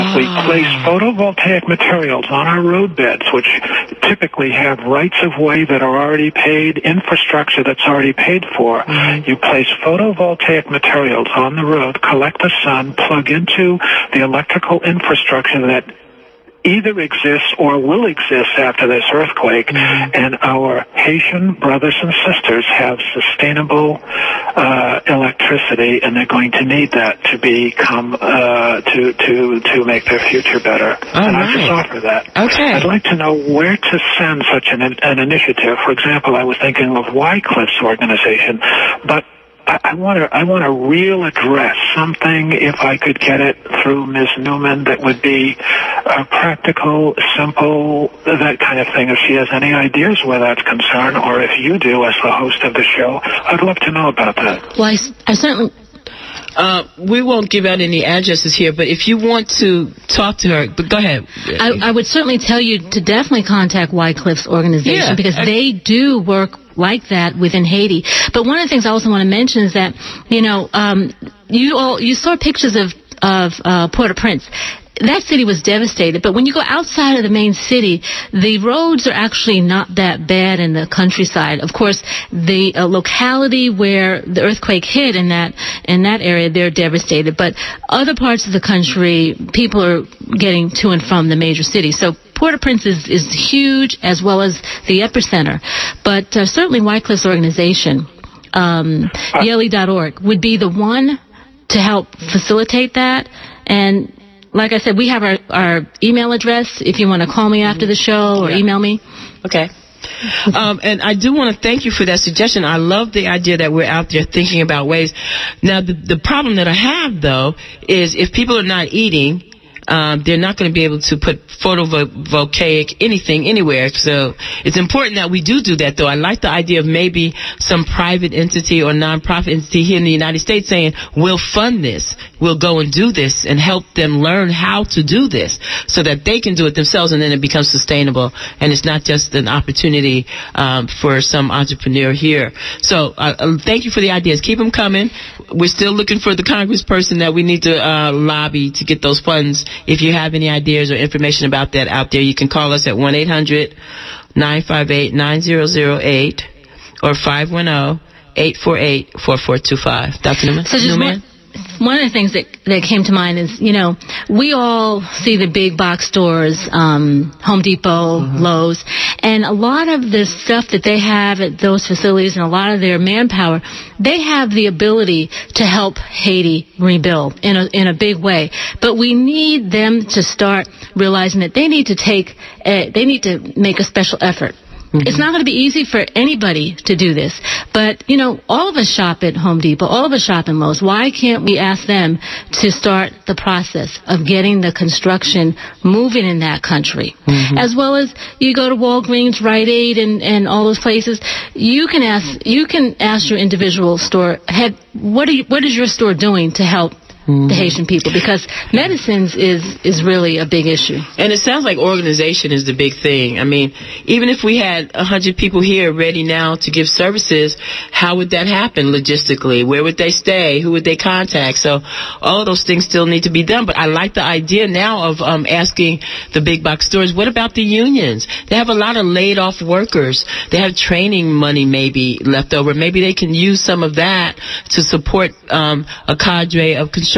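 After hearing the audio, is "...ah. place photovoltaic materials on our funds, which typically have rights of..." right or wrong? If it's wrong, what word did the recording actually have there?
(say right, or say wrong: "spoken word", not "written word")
wrong: "roadbeds", not "funds".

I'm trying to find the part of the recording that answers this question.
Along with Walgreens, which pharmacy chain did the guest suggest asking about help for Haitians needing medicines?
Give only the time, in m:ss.
3:19.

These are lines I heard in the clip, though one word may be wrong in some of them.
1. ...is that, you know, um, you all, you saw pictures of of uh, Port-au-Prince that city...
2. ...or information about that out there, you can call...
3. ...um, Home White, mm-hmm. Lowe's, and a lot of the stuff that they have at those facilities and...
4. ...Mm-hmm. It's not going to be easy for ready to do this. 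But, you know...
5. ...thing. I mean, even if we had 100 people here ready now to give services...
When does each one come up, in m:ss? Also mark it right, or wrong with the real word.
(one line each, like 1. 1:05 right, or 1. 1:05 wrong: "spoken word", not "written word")
1. 1:09 right
2. 2:30 right
3. 2:46 wrong: "Depot", not "White"
4. 3:04 wrong: "anybody", not "ready"
5. 3:33 right.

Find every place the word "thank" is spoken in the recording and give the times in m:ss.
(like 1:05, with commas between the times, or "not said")
1:51, 2:23.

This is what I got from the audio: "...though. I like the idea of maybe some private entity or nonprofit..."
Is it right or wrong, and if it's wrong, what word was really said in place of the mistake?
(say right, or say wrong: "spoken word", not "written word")
right.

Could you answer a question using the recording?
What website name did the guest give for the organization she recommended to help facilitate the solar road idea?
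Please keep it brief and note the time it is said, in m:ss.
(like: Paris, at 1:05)
Yele.org, at 1:39.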